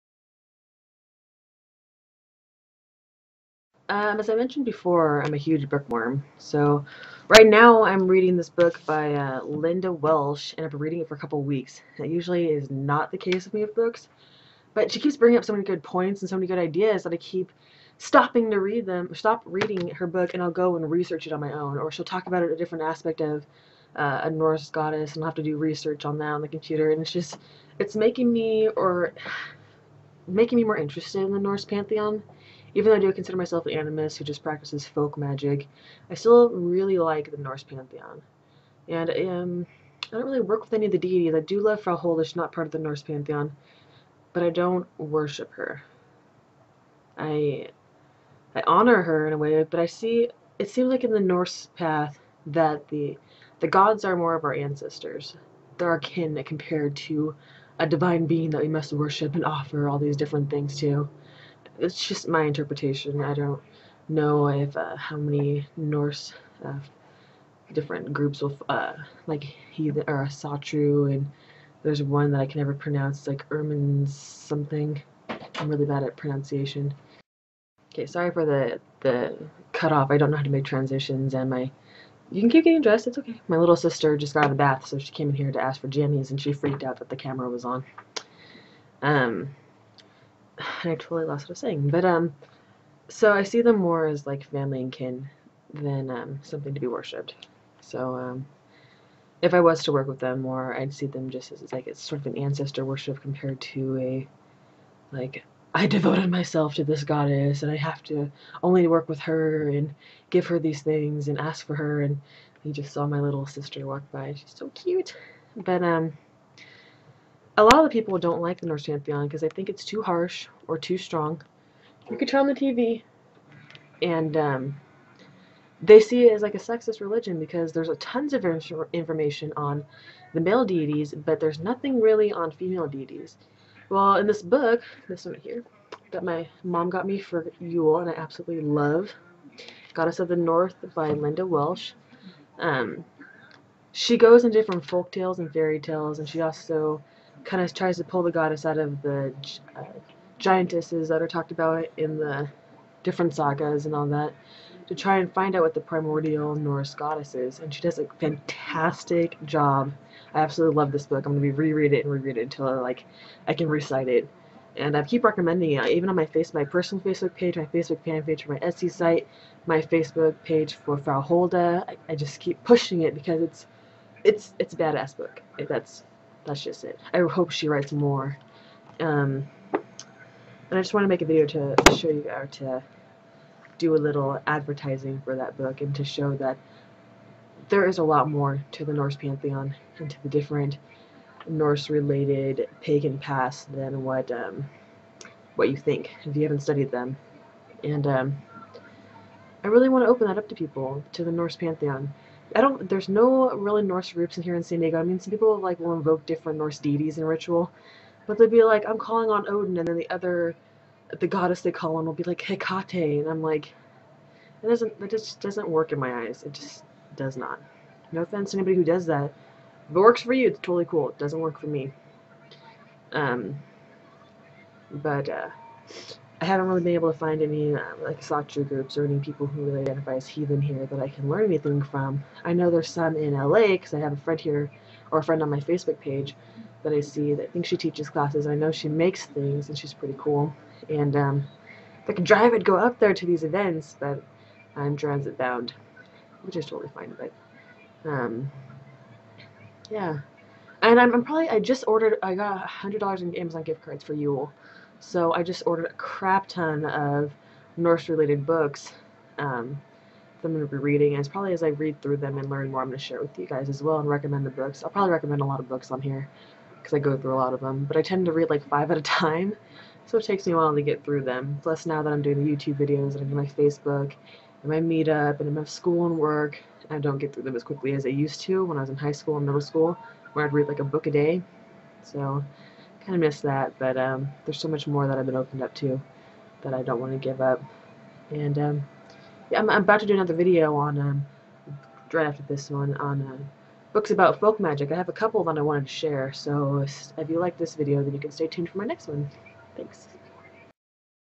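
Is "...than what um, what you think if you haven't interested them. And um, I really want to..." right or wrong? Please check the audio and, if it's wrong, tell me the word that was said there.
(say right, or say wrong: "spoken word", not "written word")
wrong: "studied", not "interested".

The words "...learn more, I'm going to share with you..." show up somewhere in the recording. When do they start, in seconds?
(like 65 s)
262 s.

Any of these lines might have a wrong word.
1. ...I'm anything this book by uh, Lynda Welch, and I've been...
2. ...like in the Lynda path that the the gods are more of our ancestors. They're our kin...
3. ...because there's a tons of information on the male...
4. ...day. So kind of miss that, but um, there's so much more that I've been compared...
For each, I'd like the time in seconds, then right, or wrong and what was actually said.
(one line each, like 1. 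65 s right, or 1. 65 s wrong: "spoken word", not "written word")
1. 7 s wrong: "reading", not "anything"
2. 50 s wrong: "Norse", not "Lynda"
3. 127 s right
4. 281 s wrong: "opened", not "compared".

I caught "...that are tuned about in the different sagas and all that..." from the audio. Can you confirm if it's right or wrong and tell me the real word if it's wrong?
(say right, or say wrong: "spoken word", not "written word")
wrong: "talked", not "tuned".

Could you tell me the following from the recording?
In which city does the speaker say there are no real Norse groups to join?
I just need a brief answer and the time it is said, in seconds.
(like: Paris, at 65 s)
San Diego, at 204 s.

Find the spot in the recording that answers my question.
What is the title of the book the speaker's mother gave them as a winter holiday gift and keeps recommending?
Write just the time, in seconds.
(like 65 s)
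139 s.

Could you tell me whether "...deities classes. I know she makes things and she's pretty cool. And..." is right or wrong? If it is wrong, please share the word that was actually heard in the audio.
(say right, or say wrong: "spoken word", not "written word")
wrong: "teaches", not "deities".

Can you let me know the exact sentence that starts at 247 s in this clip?
But um, yeah, and I'm, I'm, probably I just ordered I got a hundred dollars in Amazon gift cards for Yule.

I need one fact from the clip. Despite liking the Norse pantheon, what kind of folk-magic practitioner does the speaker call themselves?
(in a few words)
animist.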